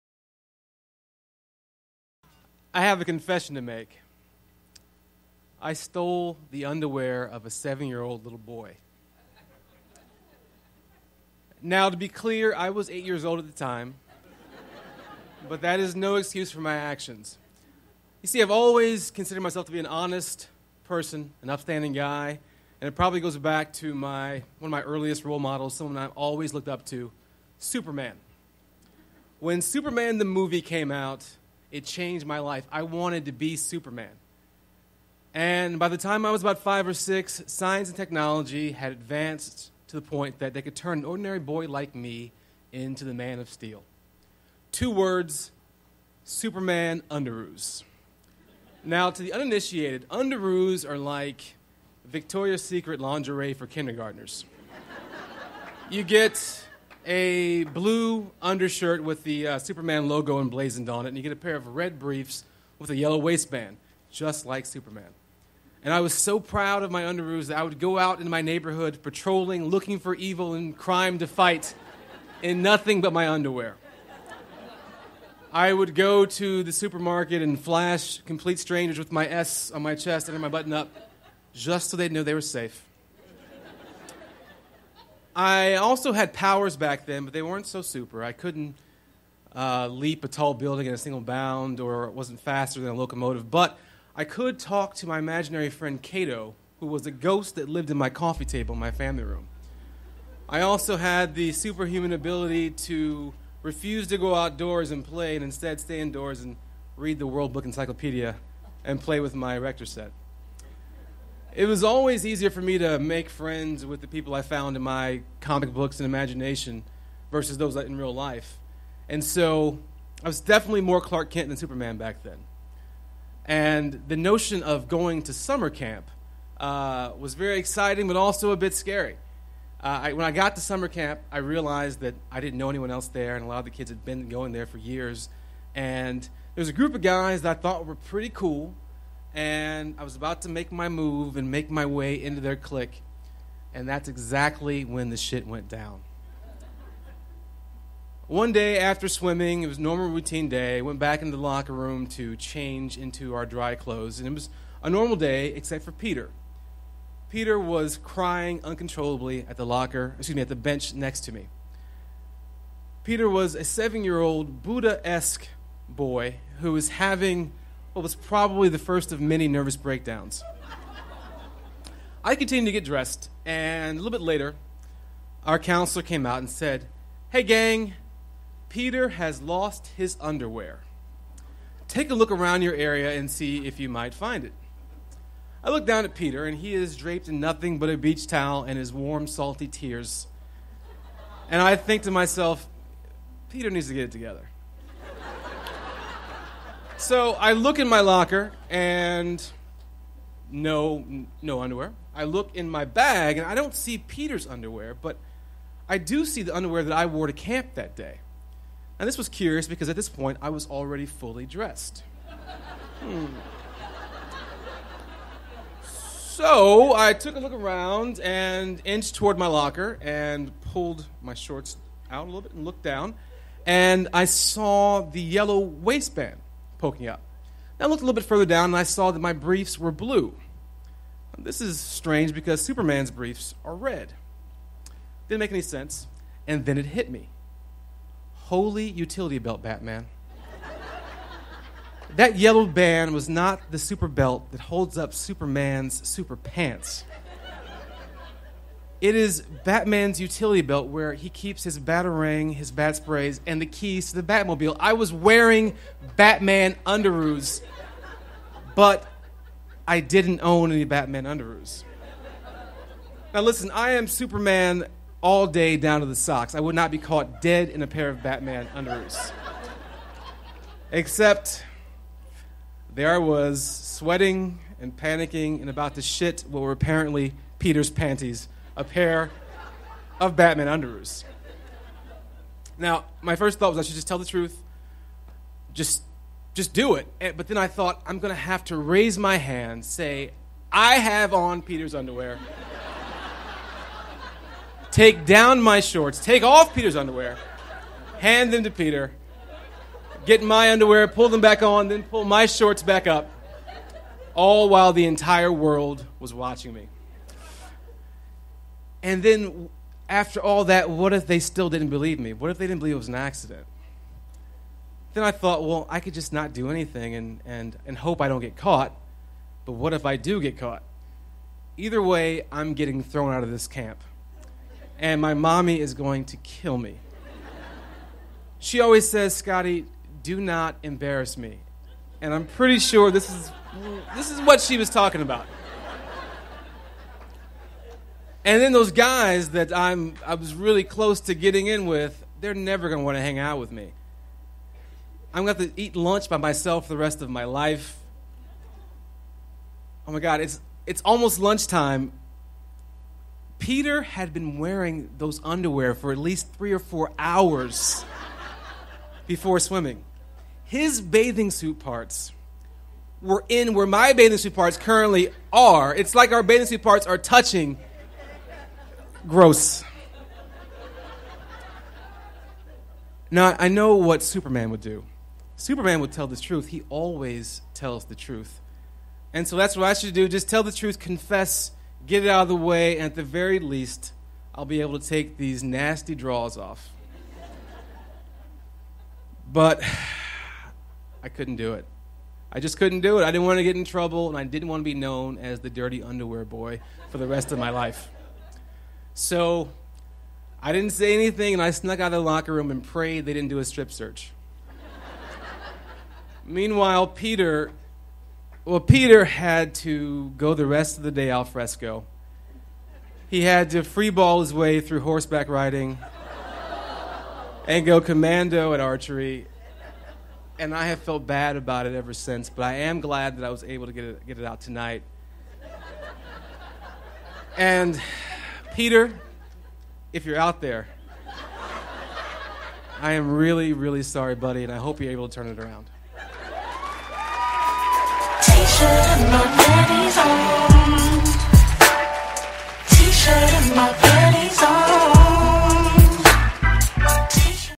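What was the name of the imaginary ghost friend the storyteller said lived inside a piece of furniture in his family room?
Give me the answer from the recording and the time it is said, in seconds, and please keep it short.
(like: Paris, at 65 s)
Cato, at 96 s.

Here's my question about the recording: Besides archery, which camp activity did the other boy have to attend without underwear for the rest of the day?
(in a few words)
Horseback riding.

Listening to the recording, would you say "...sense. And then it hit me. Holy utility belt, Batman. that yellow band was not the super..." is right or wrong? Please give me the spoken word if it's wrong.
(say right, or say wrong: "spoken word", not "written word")
right.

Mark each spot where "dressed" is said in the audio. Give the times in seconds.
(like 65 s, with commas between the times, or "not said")
172 s, 211 s.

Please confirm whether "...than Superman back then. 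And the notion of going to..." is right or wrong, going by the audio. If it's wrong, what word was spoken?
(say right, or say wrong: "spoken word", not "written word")
right.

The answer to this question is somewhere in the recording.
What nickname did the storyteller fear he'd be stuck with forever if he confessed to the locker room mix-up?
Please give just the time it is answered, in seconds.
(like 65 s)
395 s.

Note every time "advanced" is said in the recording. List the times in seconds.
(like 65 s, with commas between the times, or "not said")
38 s.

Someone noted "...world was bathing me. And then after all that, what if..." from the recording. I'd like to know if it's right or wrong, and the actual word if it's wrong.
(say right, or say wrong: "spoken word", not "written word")
wrong: "watching", not "bathing".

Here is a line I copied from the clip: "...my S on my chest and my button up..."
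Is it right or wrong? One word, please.
right.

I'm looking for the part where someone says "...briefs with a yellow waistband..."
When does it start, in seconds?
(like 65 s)
61 s.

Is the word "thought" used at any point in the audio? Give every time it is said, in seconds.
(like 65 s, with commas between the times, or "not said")
137 s, 283 s, 287 s, 315 s.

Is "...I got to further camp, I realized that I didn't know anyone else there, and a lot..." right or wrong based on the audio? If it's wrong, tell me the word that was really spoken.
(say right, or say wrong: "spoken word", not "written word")
wrong: "summer", not "further".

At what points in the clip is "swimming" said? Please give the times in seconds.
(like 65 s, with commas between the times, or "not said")
149 s, 359 s.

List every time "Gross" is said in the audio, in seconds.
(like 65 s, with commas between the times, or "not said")
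369 s.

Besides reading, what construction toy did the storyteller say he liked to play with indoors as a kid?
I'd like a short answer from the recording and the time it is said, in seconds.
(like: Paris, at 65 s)
Erector set, at 109 s.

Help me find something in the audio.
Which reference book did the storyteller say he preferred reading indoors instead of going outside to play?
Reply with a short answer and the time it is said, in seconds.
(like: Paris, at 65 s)
World Book Encyclopedia, at 107 s.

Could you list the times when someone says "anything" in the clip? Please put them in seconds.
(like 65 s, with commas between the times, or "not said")
316 s, 401 s.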